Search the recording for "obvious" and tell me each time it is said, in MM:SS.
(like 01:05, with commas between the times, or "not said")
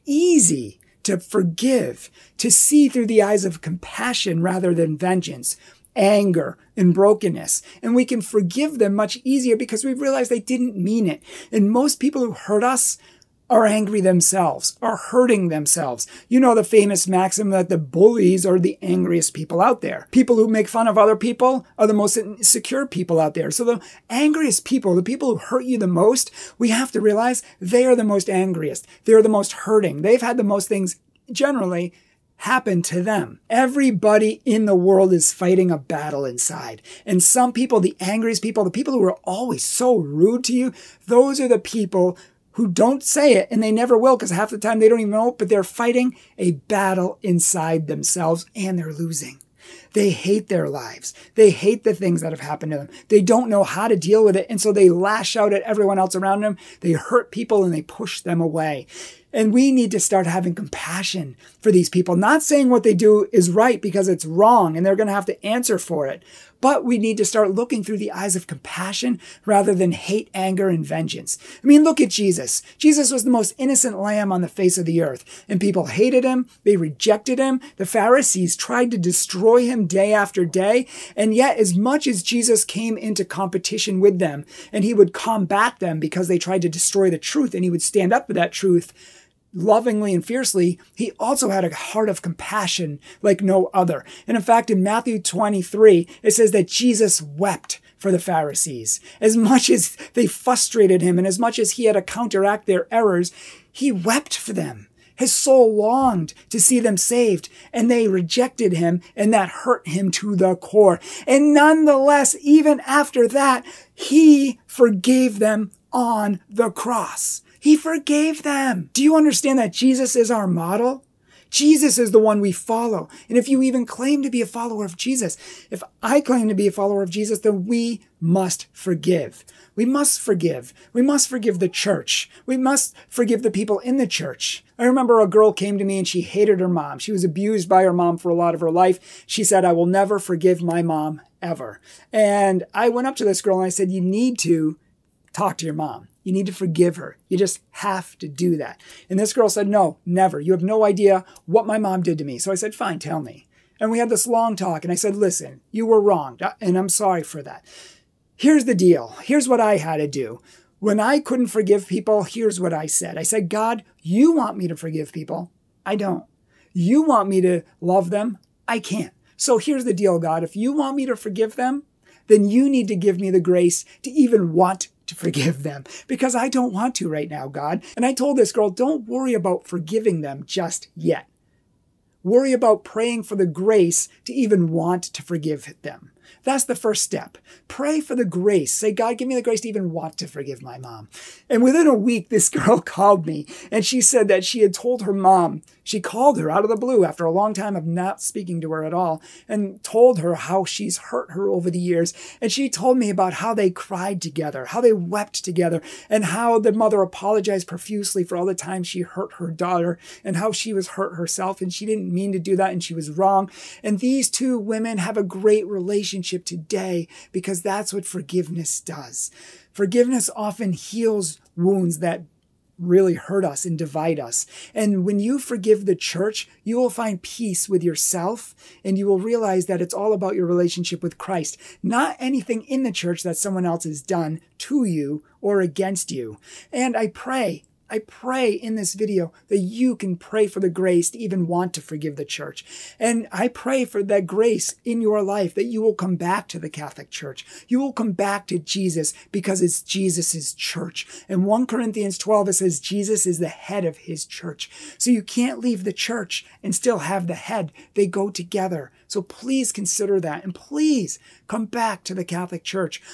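not said.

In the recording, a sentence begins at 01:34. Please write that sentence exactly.
And in fact, in Matthew 23, it says that Jesus wept for the Pharisees.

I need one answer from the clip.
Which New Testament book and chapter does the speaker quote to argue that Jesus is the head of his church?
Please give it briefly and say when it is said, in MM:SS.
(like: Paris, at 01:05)
1 Corinthians 12, at 04:11.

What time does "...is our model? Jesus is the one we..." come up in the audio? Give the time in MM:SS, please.
02:00.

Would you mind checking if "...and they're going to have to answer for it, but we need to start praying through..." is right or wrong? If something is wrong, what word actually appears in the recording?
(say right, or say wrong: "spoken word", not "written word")
wrong: "looking", not "praying".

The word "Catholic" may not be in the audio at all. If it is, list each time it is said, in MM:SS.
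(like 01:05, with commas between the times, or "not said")
04:06, 04:22.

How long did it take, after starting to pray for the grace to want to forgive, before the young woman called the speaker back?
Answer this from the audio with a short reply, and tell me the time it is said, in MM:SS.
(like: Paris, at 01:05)
Within a week, at 03:11.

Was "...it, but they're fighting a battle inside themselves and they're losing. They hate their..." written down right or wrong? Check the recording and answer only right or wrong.
right.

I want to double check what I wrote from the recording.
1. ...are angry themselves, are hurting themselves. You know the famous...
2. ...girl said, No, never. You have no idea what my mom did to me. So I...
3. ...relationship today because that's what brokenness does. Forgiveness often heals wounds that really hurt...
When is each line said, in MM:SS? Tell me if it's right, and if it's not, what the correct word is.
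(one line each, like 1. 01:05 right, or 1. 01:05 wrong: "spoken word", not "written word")
1. 00:13 right
2. 02:29 right
3. 03:35 wrong: "forgiveness", not "brokenness".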